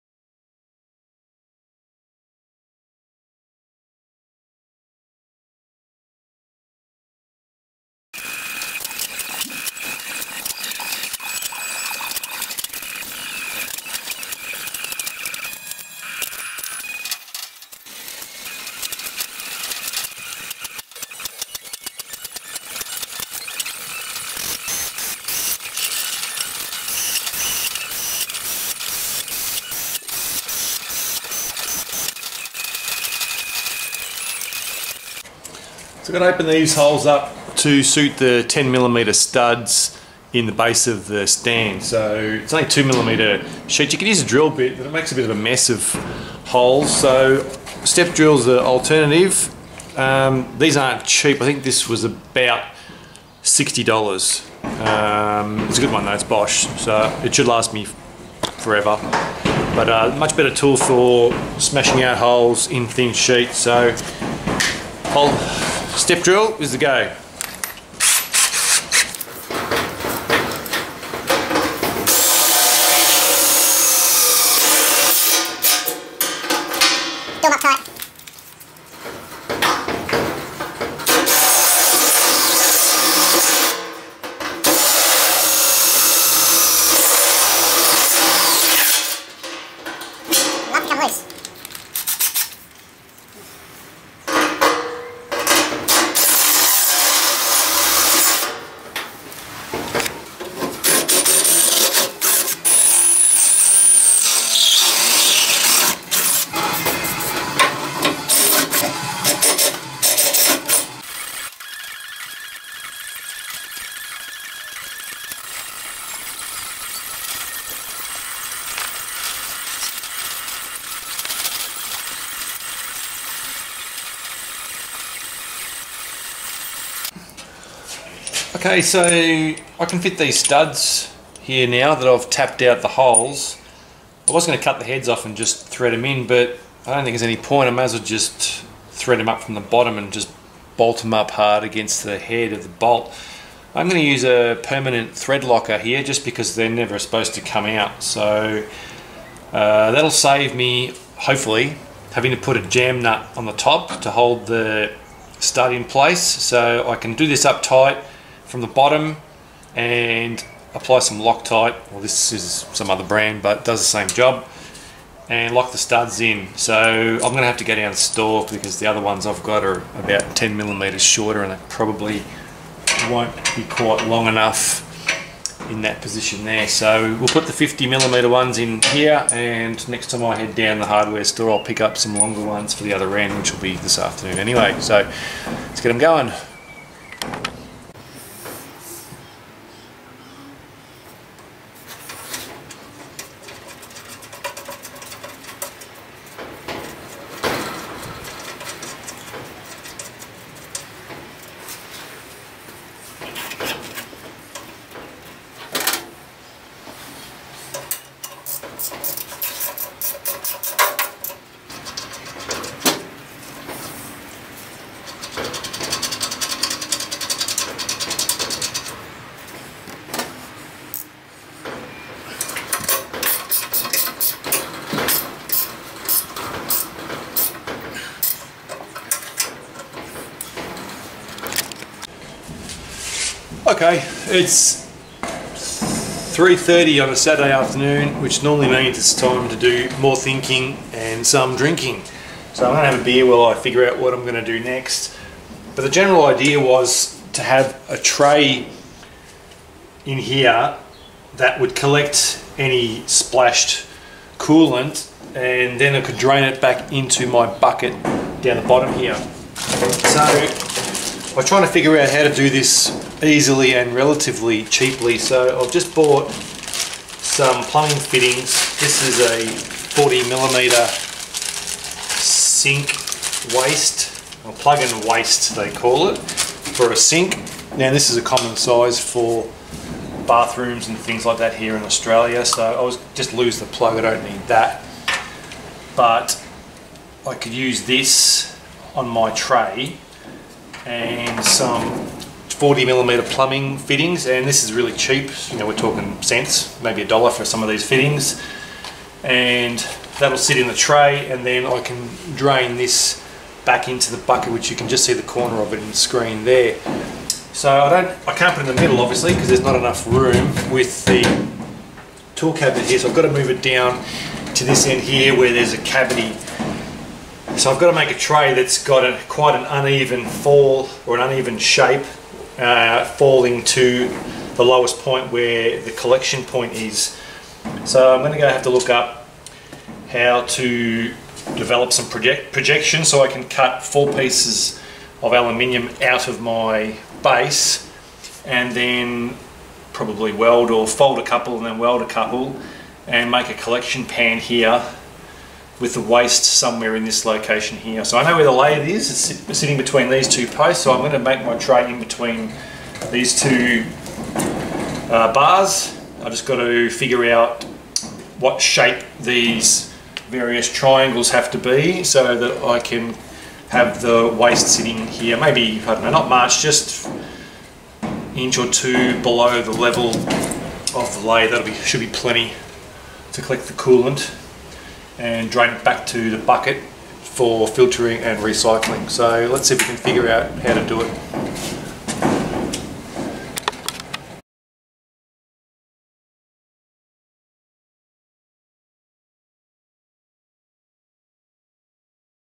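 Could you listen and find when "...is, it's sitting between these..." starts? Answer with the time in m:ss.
5:48.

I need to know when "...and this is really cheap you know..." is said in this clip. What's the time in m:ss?
4:54.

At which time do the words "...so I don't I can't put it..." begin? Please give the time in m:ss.
5:07.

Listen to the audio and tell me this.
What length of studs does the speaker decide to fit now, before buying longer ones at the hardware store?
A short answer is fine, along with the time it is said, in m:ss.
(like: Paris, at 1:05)
50 millimeter, at 2:57.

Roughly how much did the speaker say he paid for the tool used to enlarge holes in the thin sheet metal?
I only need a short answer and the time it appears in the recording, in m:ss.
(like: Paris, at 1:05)
$60, at 0:53.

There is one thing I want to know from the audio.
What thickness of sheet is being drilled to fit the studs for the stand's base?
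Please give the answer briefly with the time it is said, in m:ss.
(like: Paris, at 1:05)
2 millimeter, at 0:42.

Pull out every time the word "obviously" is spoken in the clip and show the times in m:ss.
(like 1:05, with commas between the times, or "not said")
5:09.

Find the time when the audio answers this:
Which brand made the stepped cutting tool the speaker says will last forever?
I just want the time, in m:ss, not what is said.
0:56.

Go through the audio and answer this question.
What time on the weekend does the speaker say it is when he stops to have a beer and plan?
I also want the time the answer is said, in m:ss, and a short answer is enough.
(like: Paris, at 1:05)
3.30, at 3:56.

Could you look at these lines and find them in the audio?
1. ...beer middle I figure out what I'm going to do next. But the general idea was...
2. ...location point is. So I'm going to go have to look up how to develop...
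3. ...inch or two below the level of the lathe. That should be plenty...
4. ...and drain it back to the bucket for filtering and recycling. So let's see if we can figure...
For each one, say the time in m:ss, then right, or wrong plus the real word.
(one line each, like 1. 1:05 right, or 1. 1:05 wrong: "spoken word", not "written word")
1. 4:03 wrong: "while", not "middle"
2. 5:25 wrong: "collection", not "location"
3. 6:08 right
4. 6:15 right.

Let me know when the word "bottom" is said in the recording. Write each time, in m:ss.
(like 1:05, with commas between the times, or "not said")
2:19, 2:38, 4:18.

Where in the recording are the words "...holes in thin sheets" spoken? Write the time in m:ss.
1:02.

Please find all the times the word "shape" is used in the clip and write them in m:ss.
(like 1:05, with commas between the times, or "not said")
5:21, 5:58.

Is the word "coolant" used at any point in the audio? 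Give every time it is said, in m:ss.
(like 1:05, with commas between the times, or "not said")
4:14, 6:13.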